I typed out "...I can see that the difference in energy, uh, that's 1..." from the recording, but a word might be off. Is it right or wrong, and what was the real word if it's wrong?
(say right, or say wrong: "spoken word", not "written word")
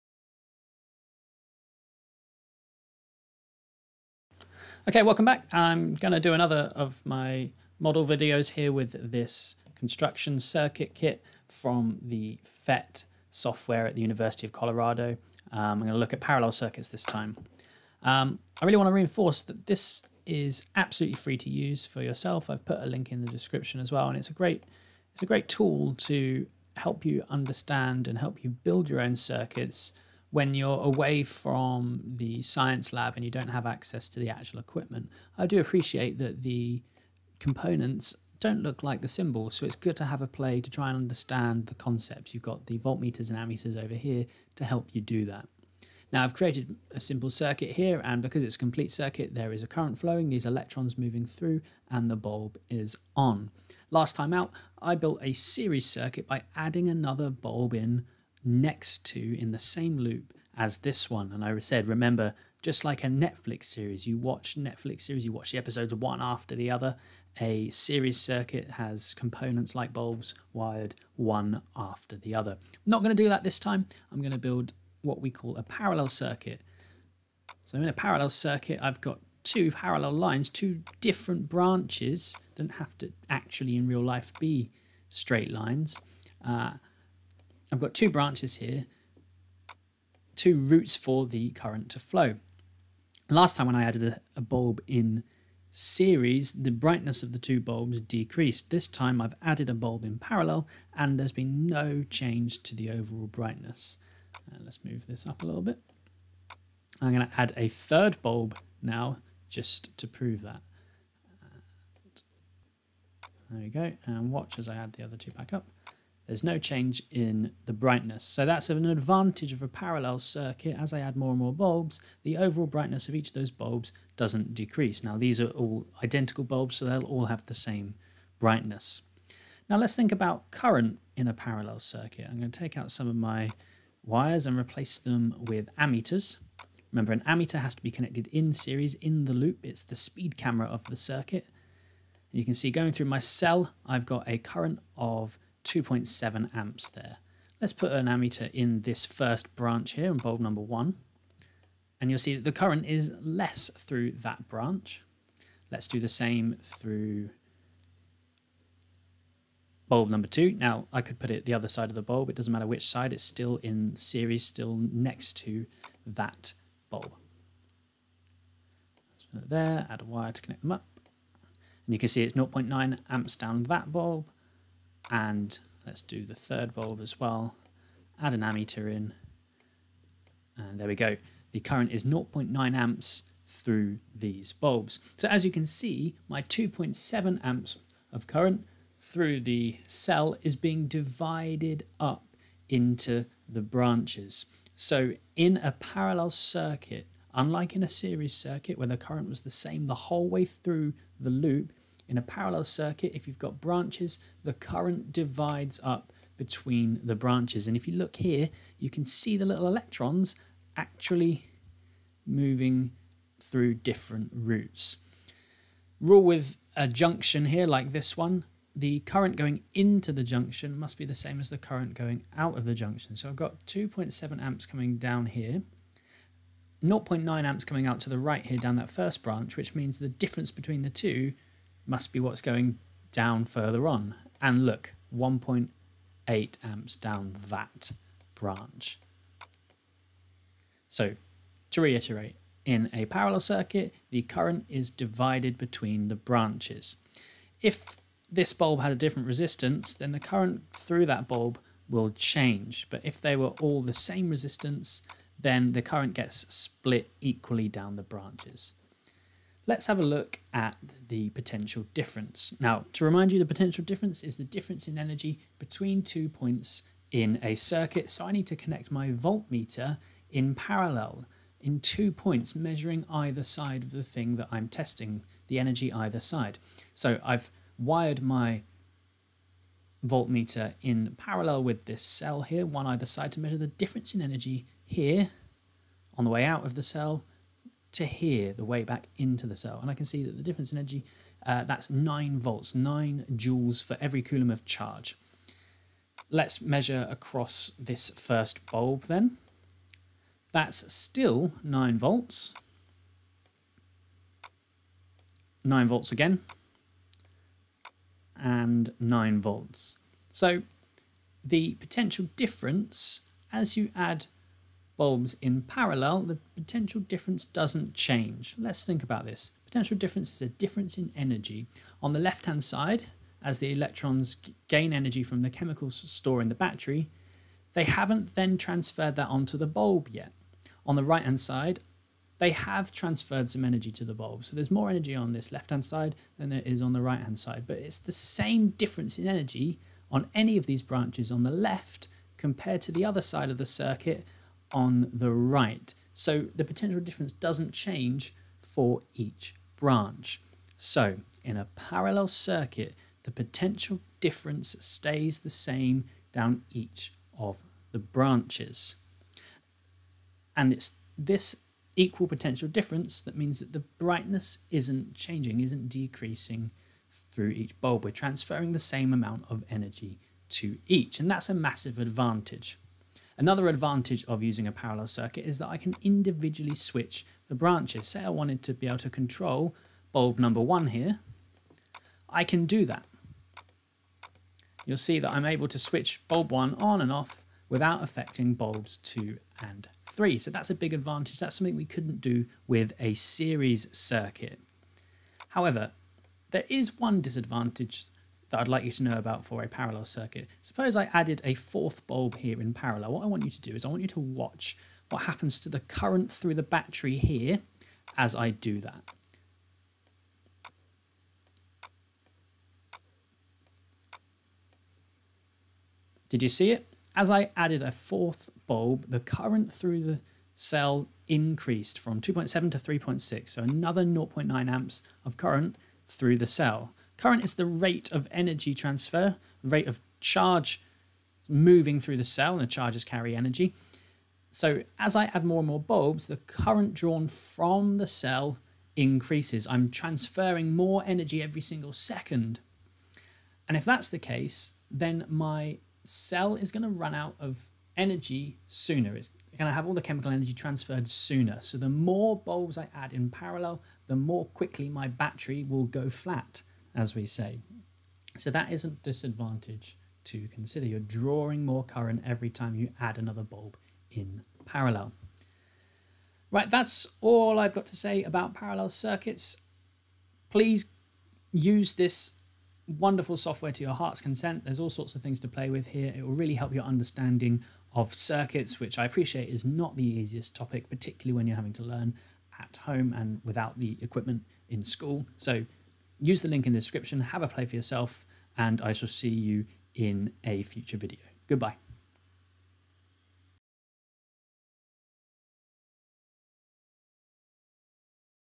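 wrong: "9", not "1".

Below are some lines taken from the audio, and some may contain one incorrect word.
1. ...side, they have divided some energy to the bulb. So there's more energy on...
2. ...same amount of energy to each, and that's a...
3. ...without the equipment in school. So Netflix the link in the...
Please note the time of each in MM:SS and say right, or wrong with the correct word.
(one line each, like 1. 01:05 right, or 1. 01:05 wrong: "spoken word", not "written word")
1. 05:31 wrong: "transferred", not "divided"
2. 06:08 right
3. 08:03 wrong: "Use", not "Netflix".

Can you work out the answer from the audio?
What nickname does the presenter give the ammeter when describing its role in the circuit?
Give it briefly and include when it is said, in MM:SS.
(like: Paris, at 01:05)
speed camera, at 02:19.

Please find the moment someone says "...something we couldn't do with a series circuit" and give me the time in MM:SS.
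06:31.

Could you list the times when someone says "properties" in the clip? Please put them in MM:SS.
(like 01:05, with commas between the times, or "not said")
not said.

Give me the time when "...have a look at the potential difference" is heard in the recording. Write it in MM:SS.
04:19.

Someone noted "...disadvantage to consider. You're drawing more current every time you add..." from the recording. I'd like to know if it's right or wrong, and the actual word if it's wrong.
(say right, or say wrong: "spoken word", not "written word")
right.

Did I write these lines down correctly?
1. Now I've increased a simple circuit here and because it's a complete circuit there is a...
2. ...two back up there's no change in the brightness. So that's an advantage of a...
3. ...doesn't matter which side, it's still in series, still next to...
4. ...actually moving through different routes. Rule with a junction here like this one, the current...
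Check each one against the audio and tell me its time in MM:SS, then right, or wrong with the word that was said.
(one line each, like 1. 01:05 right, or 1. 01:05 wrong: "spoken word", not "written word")
1. 00:46 wrong: "created", not "increased"
2. 01:55 right
3. 02:42 right
4. 03:30 right.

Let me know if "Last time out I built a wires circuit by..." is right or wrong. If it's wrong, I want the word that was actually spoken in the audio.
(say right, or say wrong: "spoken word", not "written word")
wrong: "series", not "wires".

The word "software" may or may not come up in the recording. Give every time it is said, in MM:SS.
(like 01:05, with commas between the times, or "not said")
00:13, 07:53.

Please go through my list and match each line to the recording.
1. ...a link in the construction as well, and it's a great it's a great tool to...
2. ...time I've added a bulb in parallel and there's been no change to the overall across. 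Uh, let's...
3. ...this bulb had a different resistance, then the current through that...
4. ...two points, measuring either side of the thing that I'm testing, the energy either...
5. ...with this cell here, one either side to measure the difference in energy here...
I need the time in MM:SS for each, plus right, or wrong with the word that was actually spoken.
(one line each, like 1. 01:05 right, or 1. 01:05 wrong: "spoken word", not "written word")
1. 00:22 wrong: "description", not "construction"
2. 01:38 wrong: "brightness", not "across"
3. 04:08 right
4. 04:31 right
5. 04:41 right.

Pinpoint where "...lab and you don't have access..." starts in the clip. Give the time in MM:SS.
00:32.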